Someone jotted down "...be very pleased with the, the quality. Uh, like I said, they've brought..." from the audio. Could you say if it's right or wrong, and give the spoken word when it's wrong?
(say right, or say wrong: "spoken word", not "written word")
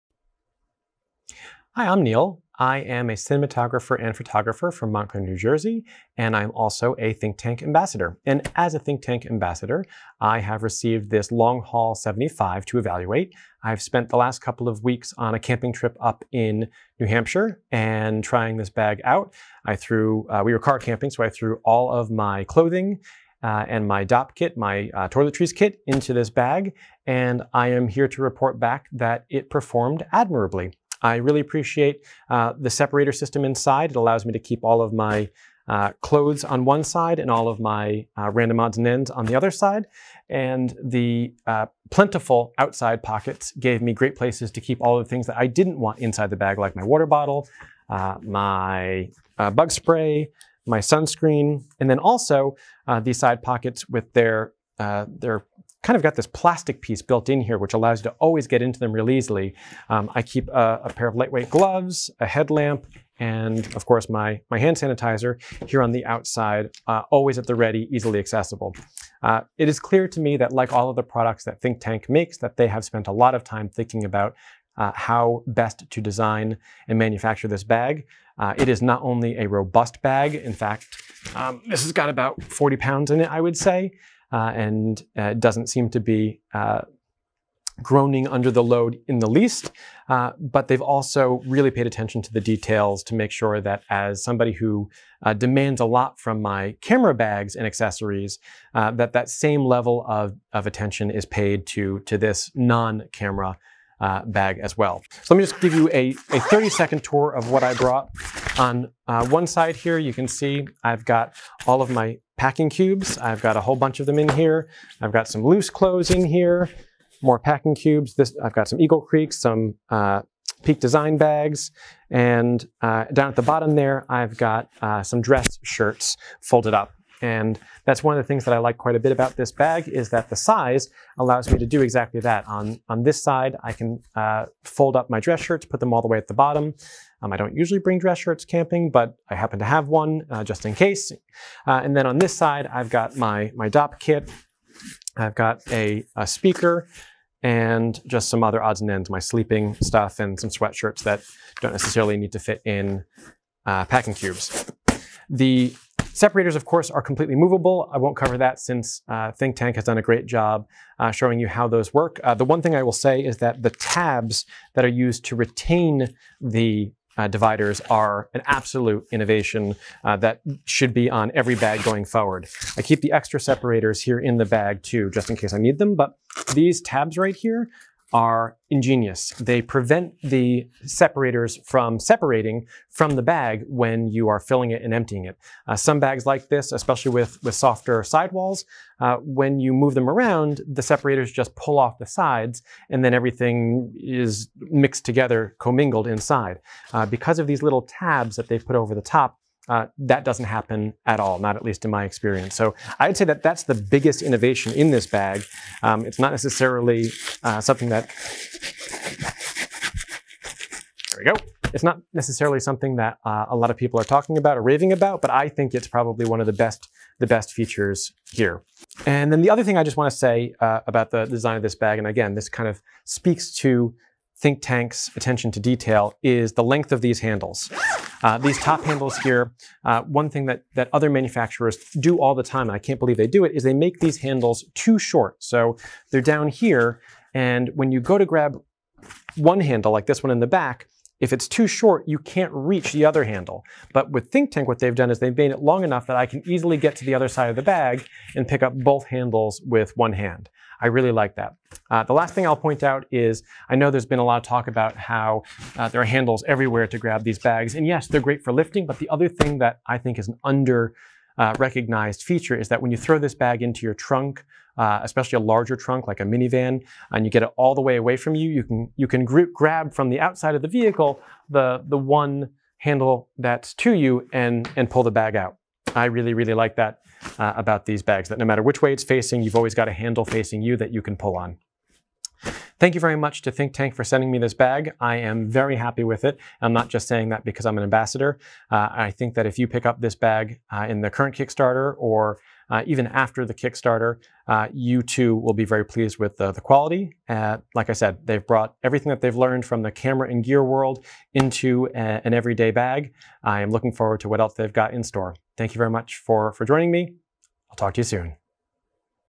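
right.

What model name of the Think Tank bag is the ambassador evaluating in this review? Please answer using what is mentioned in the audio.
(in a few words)
Long Haul 75.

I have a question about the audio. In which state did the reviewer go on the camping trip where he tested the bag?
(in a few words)
New Hampshire.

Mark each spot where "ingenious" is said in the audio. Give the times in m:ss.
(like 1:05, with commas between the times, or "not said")
2:58.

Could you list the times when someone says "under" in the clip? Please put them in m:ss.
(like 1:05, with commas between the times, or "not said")
1:28, 4:20.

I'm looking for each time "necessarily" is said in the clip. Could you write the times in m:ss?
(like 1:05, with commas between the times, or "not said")
2:31, 3:26, 3:32.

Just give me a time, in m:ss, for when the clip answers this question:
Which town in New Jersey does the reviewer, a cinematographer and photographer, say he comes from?
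0:04.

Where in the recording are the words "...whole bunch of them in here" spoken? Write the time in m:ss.
1:53.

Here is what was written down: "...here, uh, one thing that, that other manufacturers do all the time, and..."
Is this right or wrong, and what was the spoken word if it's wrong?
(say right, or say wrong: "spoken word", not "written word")
right.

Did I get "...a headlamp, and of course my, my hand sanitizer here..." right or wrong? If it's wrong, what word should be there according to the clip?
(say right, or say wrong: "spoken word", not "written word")
right.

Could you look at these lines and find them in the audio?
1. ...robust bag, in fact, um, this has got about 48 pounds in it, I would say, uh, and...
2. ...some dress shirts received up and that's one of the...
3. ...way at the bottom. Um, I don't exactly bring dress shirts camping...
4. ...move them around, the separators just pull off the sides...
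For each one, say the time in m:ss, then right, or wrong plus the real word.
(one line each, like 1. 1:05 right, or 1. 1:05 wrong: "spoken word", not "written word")
1. 1:19 wrong: "40", not "48"
2. 2:05 wrong: "folded", not "received"
3. 2:16 wrong: "usually", not "exactly"
4. 3:09 right.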